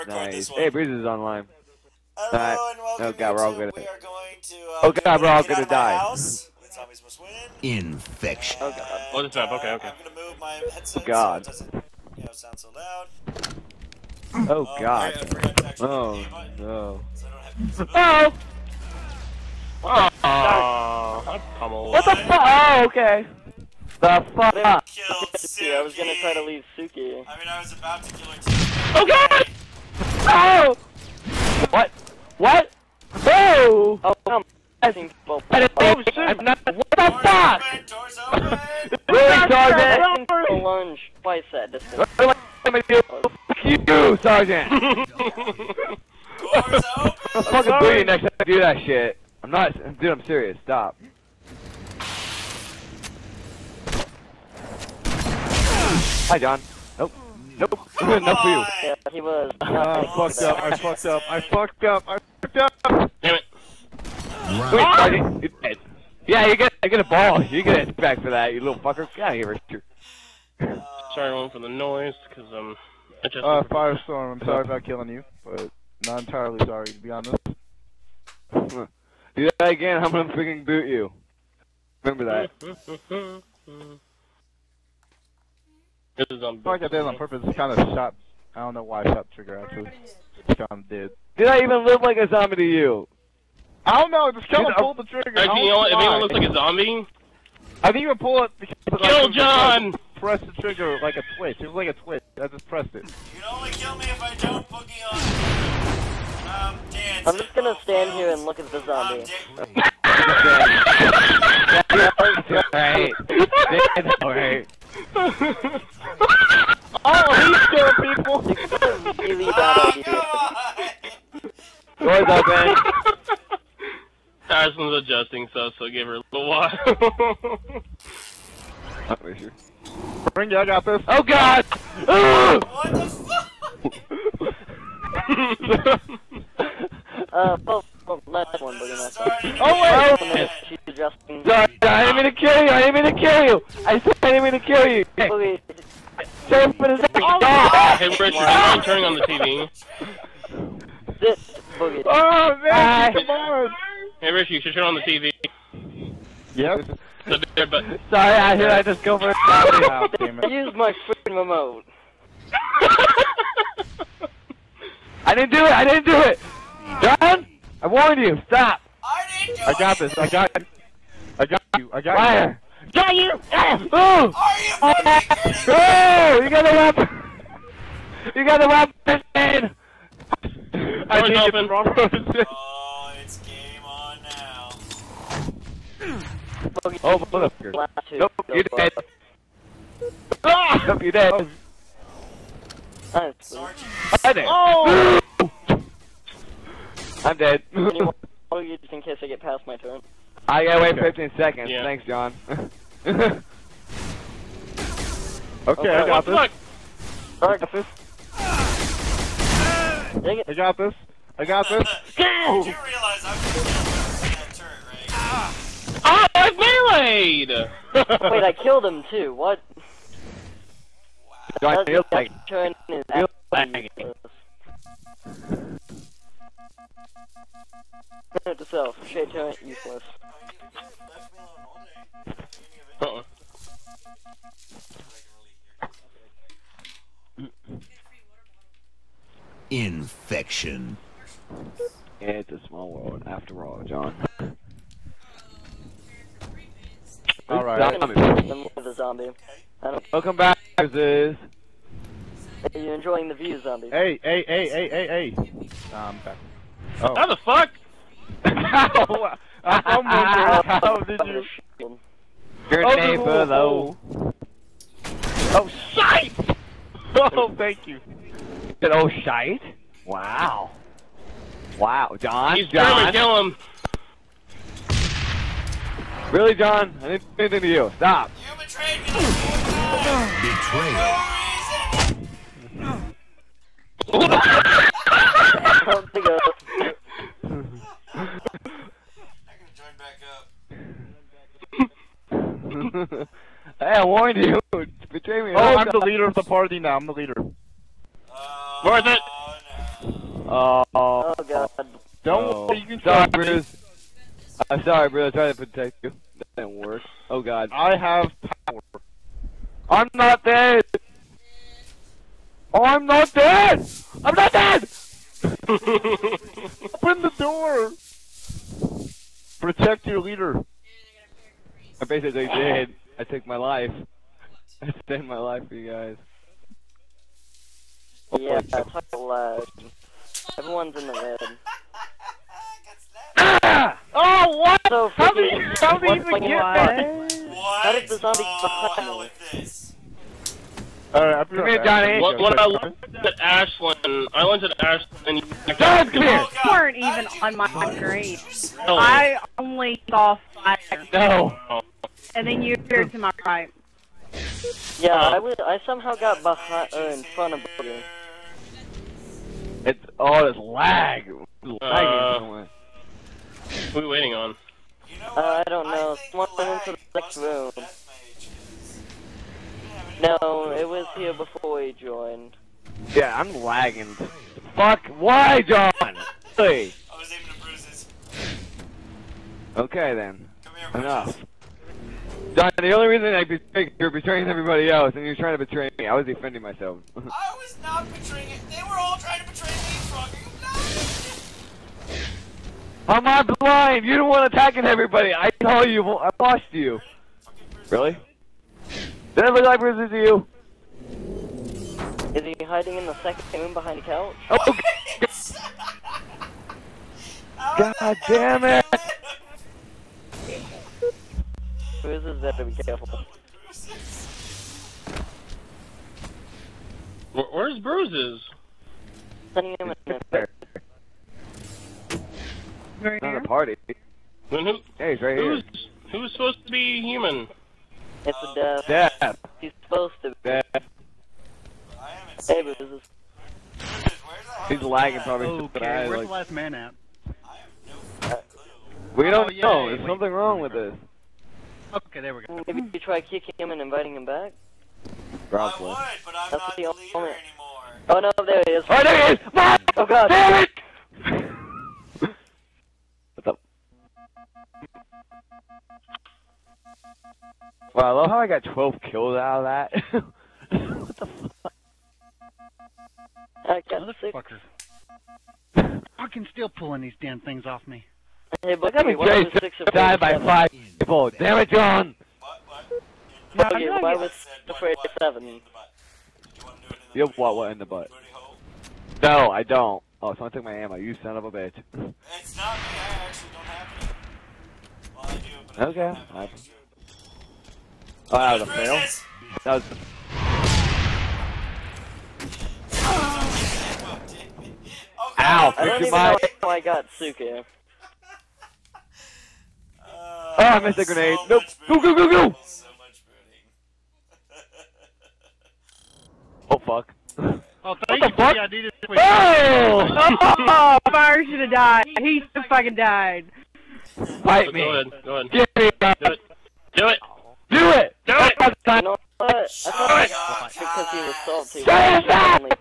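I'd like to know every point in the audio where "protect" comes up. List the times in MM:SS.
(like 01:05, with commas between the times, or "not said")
05:05, 05:19.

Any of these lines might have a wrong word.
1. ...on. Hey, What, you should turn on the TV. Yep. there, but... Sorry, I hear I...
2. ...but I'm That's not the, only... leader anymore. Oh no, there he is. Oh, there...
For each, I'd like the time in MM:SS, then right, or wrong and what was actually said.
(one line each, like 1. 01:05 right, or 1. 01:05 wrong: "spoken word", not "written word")
1. 02:33 wrong: "Richard", not "What"
2. 07:26 right.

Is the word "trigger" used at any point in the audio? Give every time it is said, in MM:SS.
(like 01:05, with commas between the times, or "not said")
01:29, 01:35, 01:40.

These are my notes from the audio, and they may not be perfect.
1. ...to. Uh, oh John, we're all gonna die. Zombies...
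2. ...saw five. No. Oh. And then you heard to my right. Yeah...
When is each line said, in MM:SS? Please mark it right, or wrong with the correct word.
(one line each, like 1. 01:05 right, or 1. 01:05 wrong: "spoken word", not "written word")
1. 00:04 wrong: "God", not "John"
2. 05:50 right.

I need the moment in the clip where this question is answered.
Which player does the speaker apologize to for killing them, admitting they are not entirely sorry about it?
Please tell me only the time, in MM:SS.
01:13.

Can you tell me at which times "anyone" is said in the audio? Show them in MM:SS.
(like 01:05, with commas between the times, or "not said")
01:35, 03:17.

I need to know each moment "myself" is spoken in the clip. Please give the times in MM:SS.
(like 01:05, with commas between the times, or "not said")
06:26.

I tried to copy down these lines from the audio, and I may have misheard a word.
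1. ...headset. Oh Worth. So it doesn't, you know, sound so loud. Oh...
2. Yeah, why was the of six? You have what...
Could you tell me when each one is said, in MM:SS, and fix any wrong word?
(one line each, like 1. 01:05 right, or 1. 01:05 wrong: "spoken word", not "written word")
1. 00:10 wrong: "God", not "Worth"
2. 07:53 wrong: "seven", not "six".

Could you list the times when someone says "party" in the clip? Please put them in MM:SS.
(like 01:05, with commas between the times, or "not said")
04:56, 07:03.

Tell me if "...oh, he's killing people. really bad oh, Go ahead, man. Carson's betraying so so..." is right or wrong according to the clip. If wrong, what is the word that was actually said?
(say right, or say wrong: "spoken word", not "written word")
wrong: "adjusting", not "betraying".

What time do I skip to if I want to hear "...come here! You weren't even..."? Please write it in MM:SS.
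05:46.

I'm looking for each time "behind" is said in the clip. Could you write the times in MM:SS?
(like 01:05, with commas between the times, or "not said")
05:56, 06:43.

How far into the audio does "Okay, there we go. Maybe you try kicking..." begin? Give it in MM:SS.
07:21.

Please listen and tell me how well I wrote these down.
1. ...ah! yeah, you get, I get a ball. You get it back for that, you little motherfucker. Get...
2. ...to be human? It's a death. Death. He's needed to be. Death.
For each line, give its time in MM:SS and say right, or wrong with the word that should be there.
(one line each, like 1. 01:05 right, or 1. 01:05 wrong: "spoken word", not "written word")
1. 01:04 wrong: "fucker", not "motherfucker"
2. 07:06 wrong: "supposed", not "needed".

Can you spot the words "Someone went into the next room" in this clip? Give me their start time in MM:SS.
06:06.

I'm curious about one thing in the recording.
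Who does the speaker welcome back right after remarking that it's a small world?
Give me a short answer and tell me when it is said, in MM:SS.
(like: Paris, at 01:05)
Ziz, at 04:10.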